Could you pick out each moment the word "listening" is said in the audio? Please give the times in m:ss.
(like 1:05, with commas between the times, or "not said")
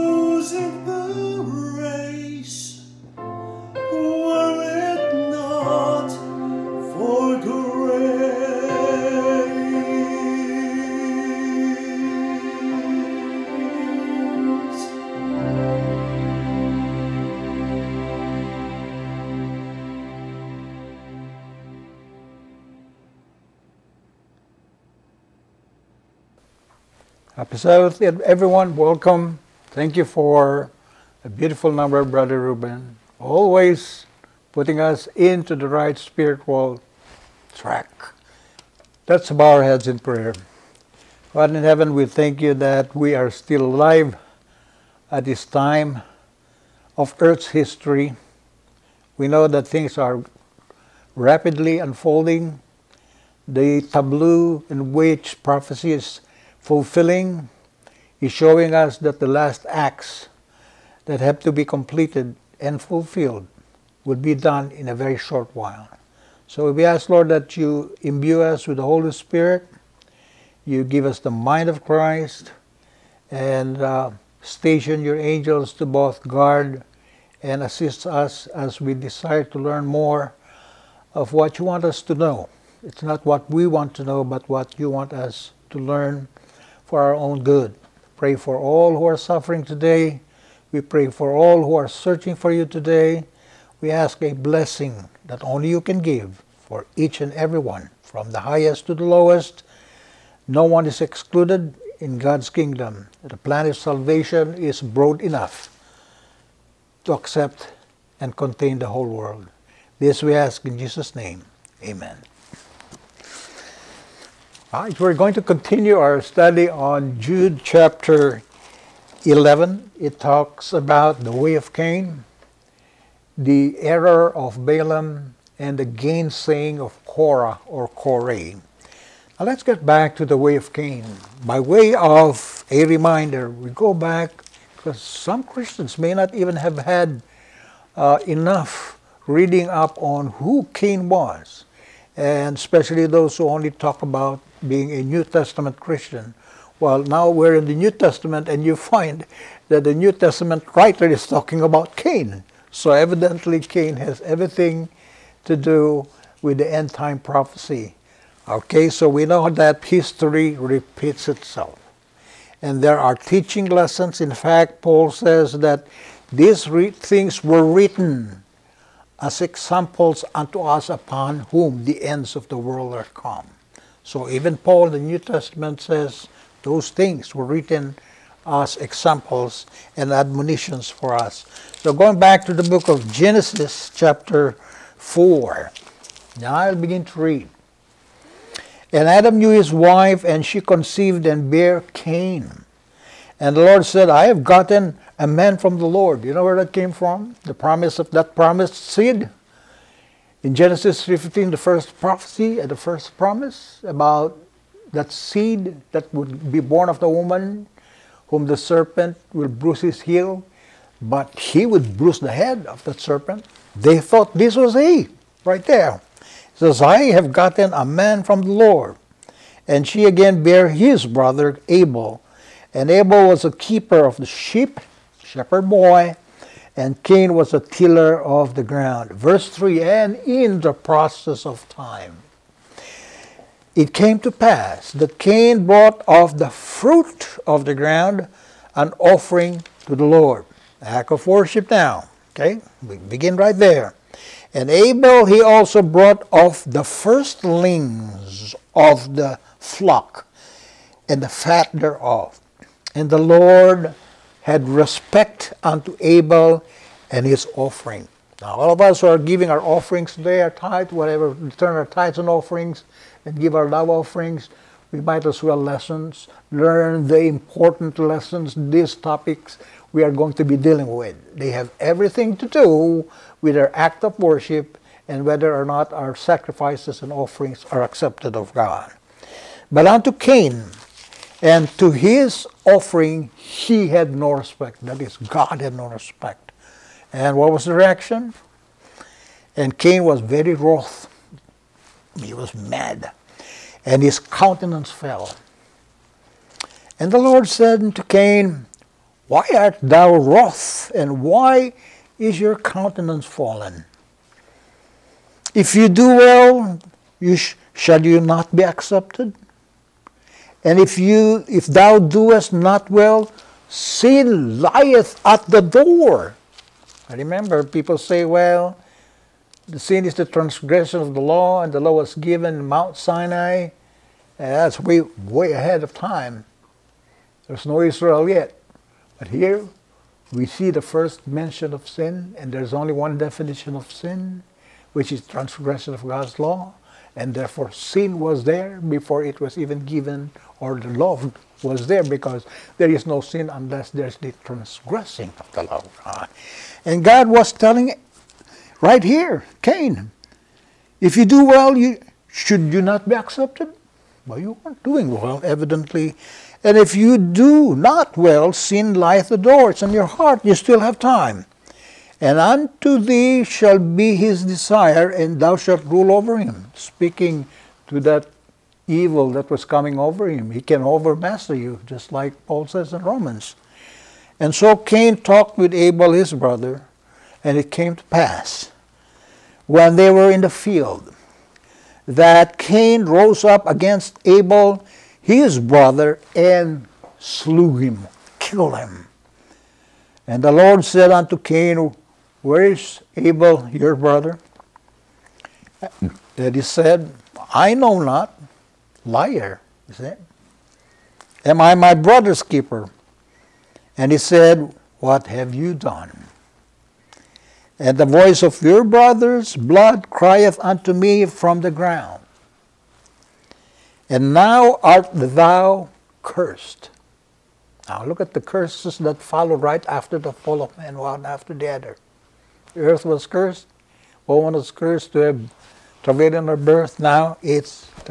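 not said.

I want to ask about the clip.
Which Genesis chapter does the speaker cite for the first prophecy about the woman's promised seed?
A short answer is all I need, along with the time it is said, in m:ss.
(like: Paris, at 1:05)
Genesis 15, at 3:20.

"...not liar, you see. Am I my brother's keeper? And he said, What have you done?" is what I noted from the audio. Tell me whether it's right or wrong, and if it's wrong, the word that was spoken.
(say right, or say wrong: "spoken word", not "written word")
right.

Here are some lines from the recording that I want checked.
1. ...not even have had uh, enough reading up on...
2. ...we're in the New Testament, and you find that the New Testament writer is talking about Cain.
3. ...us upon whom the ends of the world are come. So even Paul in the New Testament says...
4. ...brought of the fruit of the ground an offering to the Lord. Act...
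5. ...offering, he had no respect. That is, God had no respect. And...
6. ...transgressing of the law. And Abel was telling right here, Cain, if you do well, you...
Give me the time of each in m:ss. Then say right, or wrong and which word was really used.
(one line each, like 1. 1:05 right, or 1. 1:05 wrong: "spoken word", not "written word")
1. 2:16 right
2. 2:27 right
3. 2:50 right
4. 3:55 right
5. 4:42 right
6. 5:44 wrong: "God", not "Abel".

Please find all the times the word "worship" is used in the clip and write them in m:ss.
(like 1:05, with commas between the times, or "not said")
4:01, 4:34.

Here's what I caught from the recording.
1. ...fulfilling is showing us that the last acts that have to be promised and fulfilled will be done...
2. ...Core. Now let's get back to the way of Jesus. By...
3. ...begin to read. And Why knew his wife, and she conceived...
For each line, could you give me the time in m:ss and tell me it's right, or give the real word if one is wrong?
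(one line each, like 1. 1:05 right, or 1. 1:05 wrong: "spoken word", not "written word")
1. 0:56 wrong: "completed", not "promised"
2. 2:07 wrong: "Cain", not "Jesus"
3. 3:06 wrong: "Adam", not "Why".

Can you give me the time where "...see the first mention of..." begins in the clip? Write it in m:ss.
5:30.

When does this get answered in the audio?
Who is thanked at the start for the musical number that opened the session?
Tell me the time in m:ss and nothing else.
0:32.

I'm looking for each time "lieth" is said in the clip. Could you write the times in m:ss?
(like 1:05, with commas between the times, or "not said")
5:14, 5:58.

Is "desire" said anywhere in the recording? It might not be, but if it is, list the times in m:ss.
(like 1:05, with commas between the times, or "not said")
1:18, 6:04.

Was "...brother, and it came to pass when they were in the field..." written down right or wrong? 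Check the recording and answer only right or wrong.
right.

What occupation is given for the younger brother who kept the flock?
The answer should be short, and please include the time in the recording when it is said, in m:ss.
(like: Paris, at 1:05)
keeper of the sheep, at 3:43.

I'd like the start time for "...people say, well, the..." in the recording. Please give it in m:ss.
5:17.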